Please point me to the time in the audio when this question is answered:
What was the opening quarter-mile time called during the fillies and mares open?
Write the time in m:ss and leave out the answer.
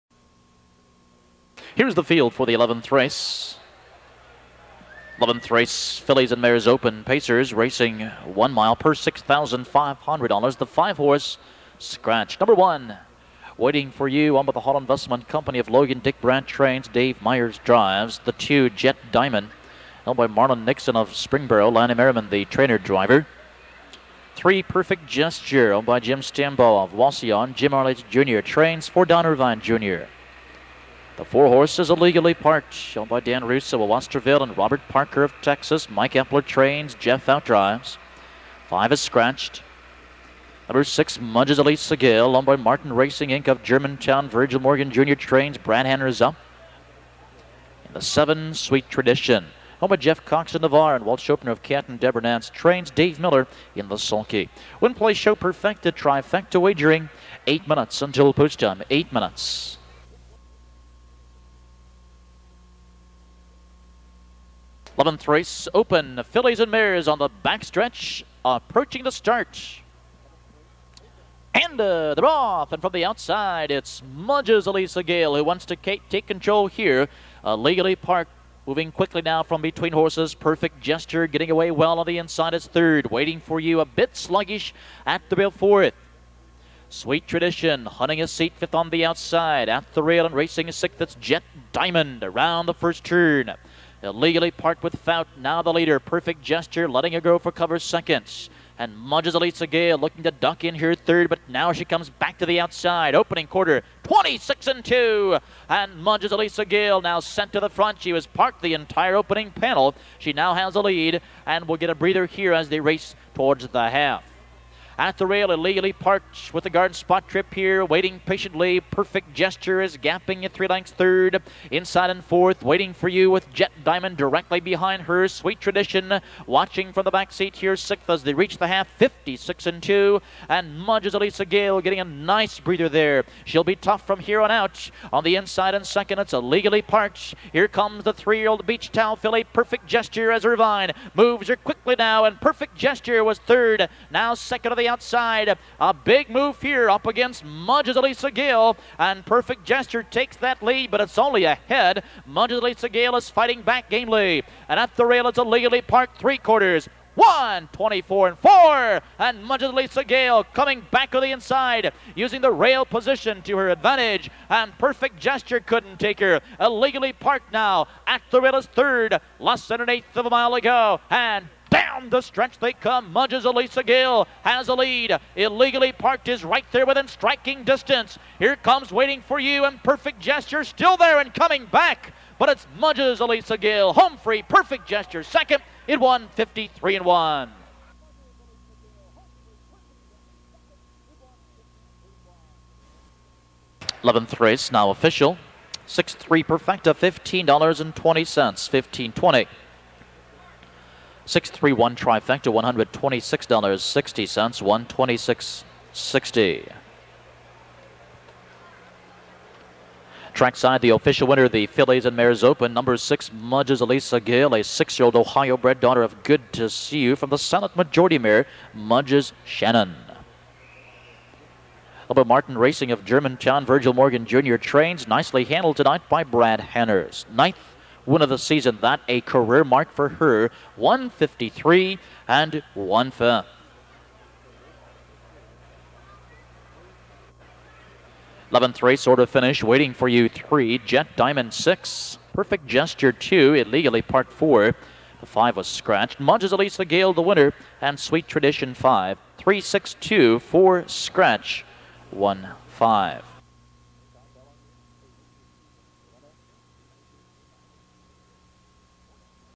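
1:44.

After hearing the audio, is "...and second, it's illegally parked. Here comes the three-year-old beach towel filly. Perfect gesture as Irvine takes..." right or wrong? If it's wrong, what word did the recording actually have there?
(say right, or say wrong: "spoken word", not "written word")
wrong: "moves", not "takes".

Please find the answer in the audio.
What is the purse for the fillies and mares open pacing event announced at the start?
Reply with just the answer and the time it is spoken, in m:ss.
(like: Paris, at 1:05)
$6,500, at 0:08.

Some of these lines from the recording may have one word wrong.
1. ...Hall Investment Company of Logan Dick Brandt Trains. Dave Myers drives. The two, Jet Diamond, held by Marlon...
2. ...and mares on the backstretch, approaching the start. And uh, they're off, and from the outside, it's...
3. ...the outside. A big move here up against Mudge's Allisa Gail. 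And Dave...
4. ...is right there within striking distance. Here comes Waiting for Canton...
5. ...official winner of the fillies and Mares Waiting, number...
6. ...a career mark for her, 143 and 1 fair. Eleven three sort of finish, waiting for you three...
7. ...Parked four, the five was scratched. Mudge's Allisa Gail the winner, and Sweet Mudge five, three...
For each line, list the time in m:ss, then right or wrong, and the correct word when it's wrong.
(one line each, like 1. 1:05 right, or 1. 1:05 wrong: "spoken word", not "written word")
1. 0:14 right
2. 1:06 right
3. 2:24 wrong: "Perfect", not "Dave"
4. 2:56 wrong: "You", not "Canton"
5. 3:30 wrong: "Open", not "Waiting"
6. 3:49 wrong: "153", not "143"
7. 4:04 wrong: "Tradition", not "Mudge".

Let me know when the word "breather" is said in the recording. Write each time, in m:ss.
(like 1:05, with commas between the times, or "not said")
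1:51, 2:12.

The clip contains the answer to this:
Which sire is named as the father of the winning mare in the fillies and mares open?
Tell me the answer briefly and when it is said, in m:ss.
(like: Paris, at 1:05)
Good to See You, at 3:36.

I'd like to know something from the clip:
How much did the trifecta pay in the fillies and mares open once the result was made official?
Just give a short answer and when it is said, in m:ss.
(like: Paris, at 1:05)
$126.60, at 3:22.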